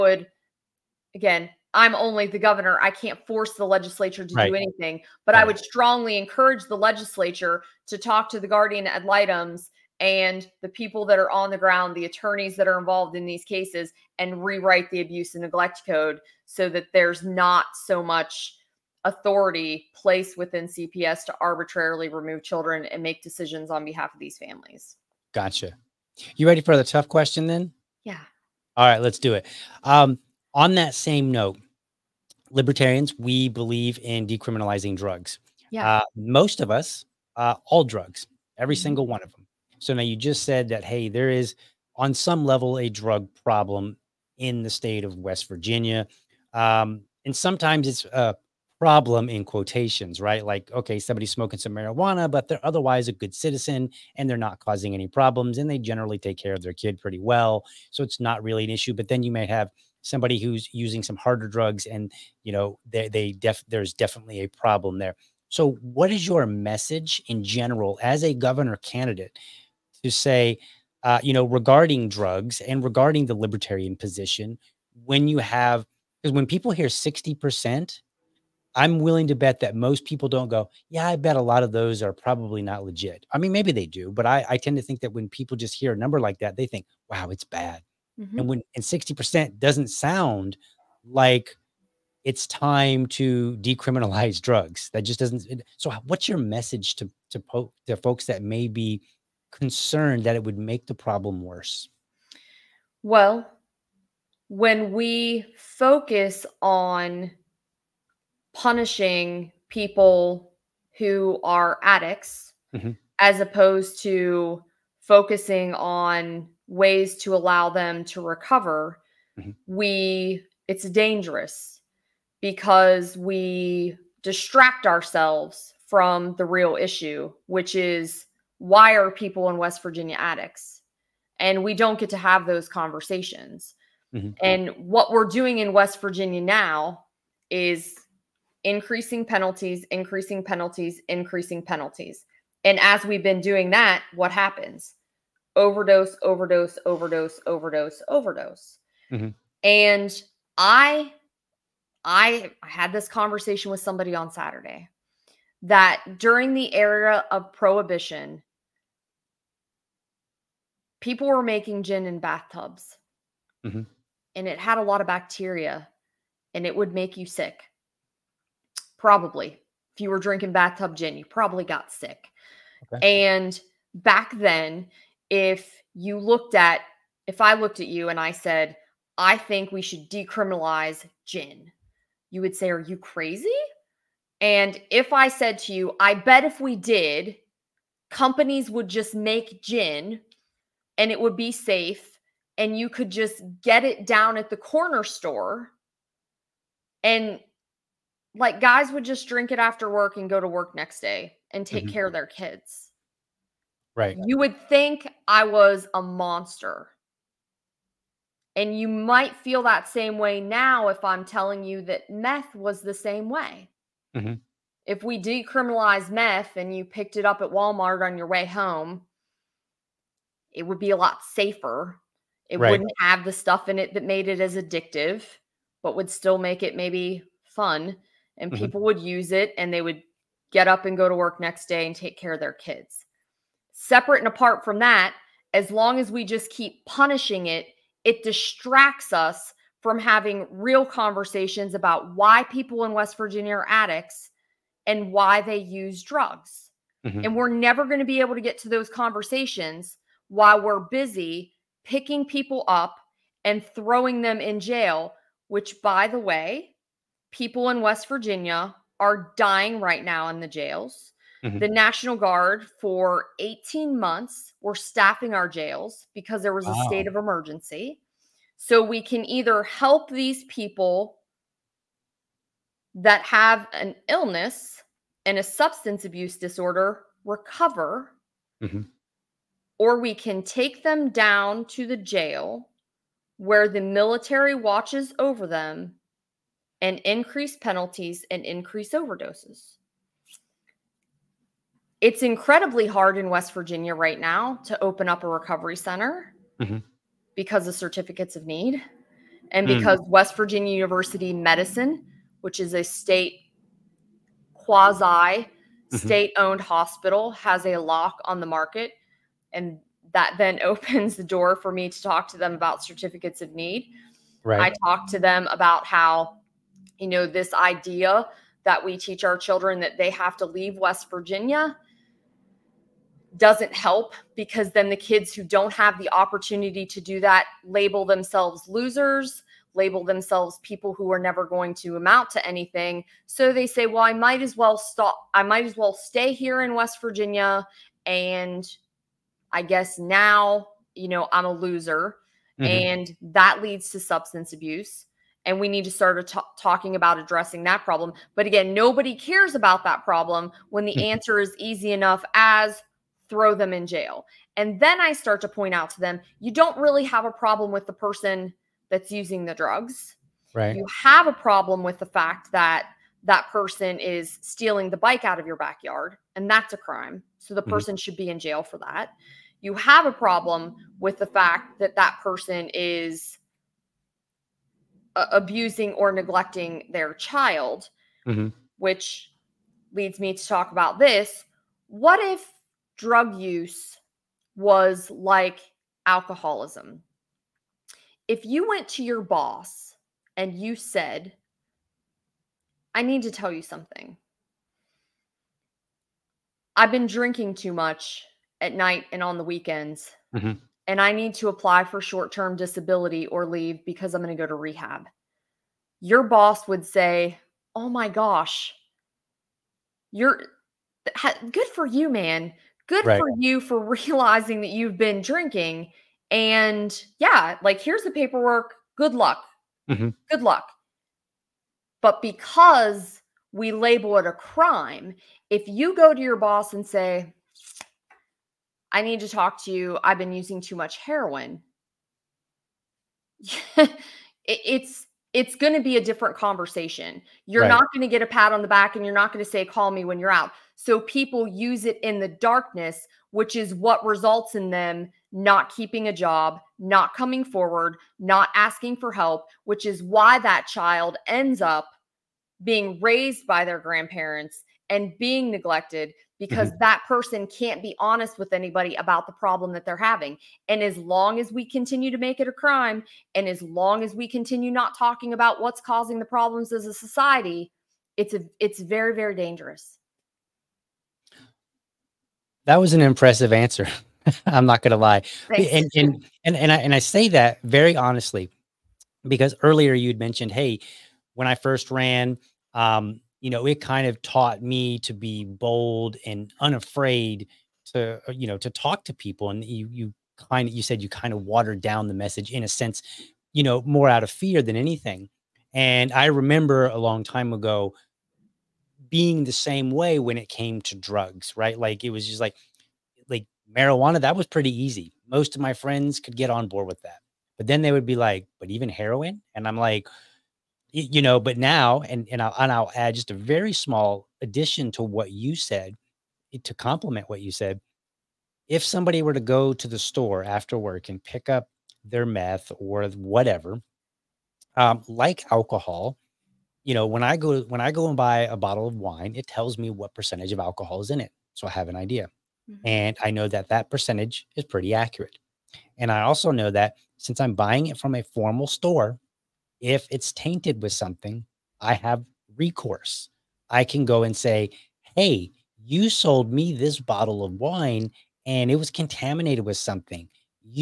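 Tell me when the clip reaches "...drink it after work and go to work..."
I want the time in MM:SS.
03:19.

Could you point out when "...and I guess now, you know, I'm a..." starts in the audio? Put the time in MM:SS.
05:38.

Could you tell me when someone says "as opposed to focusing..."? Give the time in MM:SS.
01:53.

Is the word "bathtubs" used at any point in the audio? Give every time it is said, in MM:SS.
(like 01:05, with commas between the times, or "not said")
02:42, 02:50.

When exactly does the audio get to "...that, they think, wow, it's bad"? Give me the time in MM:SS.
01:26.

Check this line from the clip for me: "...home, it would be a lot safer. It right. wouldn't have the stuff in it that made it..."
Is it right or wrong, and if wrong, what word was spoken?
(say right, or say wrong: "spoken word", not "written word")
right.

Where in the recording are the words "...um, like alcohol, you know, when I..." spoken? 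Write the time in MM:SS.
08:44.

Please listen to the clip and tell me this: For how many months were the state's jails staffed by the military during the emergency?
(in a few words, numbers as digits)
18.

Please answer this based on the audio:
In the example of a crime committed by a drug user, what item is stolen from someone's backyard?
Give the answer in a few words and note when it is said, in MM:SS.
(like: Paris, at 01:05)
bike, at 06:04.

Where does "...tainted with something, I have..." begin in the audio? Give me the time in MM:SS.
09:00.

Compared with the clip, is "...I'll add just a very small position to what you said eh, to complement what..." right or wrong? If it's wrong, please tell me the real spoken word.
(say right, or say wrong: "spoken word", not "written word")
wrong: "addition", not "position".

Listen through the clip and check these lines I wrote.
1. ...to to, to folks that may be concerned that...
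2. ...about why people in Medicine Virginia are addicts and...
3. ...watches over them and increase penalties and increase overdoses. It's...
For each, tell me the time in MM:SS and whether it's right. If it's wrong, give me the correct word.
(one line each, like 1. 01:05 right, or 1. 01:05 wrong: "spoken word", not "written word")
1. 01:36 right
2. 04:01 wrong: "West", not "Medicine"
3. 04:44 right.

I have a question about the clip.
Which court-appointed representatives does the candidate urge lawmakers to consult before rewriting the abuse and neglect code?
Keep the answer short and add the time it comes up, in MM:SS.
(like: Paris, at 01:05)
guardian ad litems, at 00:08.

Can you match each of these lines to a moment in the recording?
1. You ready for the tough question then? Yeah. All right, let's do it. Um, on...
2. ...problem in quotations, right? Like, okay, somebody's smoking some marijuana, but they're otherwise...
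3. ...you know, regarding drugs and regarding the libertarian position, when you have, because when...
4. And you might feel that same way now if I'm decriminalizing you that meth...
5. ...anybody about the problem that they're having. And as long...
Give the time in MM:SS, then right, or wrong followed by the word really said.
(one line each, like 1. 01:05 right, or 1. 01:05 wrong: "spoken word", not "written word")
1. 00:26 right
2. 00:48 right
3. 01:11 right
4. 03:28 wrong: "telling", not "decriminalizing"
5. 07:38 right.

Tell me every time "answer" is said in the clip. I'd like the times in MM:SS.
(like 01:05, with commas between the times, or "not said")
05:51, 07:53.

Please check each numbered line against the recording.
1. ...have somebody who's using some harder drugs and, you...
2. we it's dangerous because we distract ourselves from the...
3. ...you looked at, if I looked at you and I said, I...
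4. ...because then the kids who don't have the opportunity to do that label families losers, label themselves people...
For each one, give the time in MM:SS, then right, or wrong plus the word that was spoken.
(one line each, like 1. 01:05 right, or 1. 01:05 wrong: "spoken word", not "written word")
1. 00:59 right
2. 01:59 right
3. 02:55 right
4. 05:24 wrong: "themselves", not "families".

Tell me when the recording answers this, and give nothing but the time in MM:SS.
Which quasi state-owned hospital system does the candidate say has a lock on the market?
05:00.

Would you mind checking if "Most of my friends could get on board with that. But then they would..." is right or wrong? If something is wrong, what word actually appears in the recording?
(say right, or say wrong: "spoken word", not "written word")
right.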